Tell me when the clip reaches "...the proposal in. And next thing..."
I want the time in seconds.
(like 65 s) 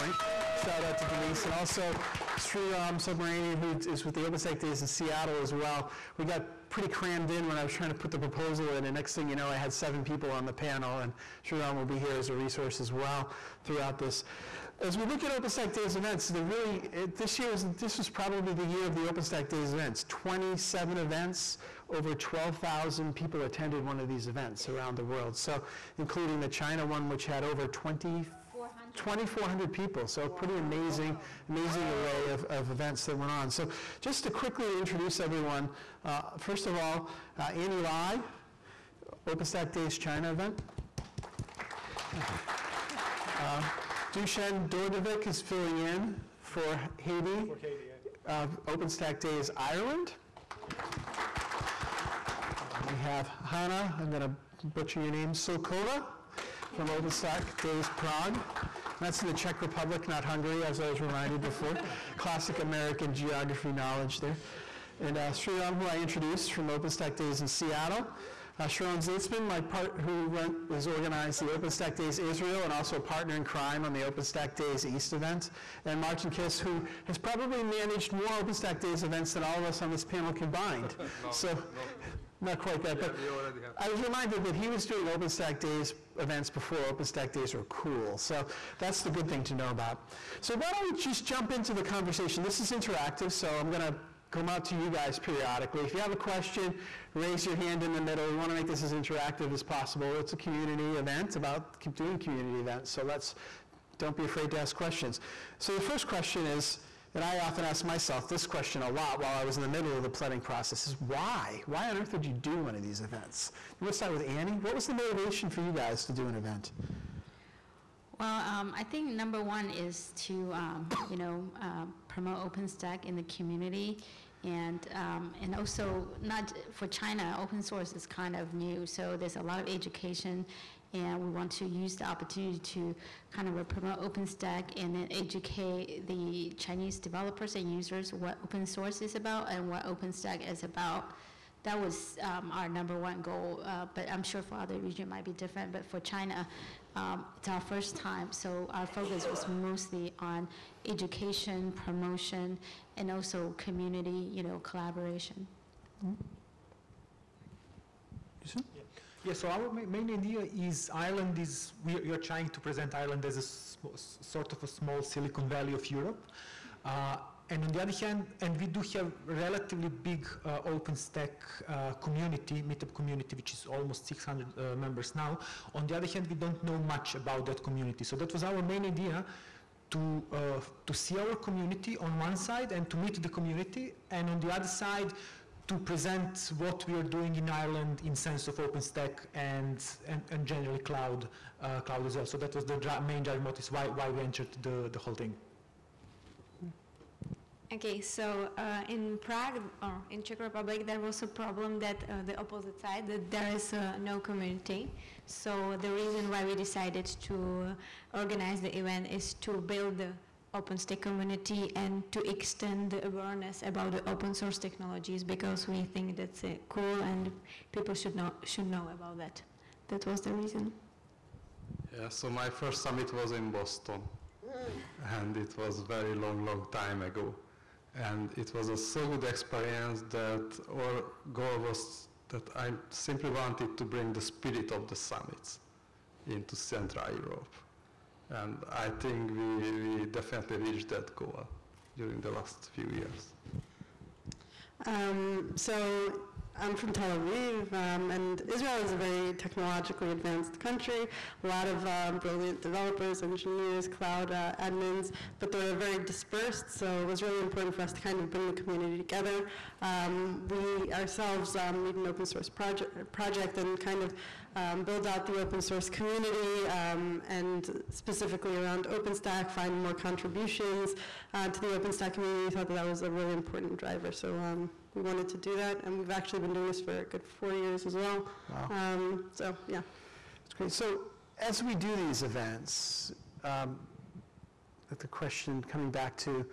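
8 s.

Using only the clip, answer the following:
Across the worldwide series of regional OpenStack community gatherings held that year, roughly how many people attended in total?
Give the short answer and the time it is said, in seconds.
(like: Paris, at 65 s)
12,000, at 22 s.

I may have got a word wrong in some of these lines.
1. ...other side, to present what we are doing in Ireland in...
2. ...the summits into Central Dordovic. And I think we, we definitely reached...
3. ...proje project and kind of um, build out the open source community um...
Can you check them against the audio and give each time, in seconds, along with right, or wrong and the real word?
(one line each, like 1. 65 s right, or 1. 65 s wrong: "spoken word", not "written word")
1. 184 s right
2. 234 s wrong: "Europe", not "Dordovic"
3. 262 s right.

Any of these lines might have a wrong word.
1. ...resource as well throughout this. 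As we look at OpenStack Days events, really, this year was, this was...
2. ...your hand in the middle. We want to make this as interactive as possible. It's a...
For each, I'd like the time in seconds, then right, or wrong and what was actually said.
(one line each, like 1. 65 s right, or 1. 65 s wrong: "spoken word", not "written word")
1. 12 s right
2. 97 s right.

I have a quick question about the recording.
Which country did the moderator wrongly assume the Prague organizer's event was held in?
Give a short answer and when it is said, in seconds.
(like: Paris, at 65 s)
Hungary, at 60 s.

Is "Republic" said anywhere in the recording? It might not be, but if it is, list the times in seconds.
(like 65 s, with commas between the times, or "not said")
59 s, 200 s.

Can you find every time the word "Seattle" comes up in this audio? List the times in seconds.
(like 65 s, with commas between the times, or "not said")
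4 s, 67 s.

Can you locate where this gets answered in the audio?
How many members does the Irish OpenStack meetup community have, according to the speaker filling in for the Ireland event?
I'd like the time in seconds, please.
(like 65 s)
173 s.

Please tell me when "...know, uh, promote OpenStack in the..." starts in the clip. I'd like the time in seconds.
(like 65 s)
121 s.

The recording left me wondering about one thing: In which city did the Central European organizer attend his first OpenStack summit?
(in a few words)
Boston.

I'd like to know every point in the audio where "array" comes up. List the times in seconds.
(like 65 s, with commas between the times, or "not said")
31 s.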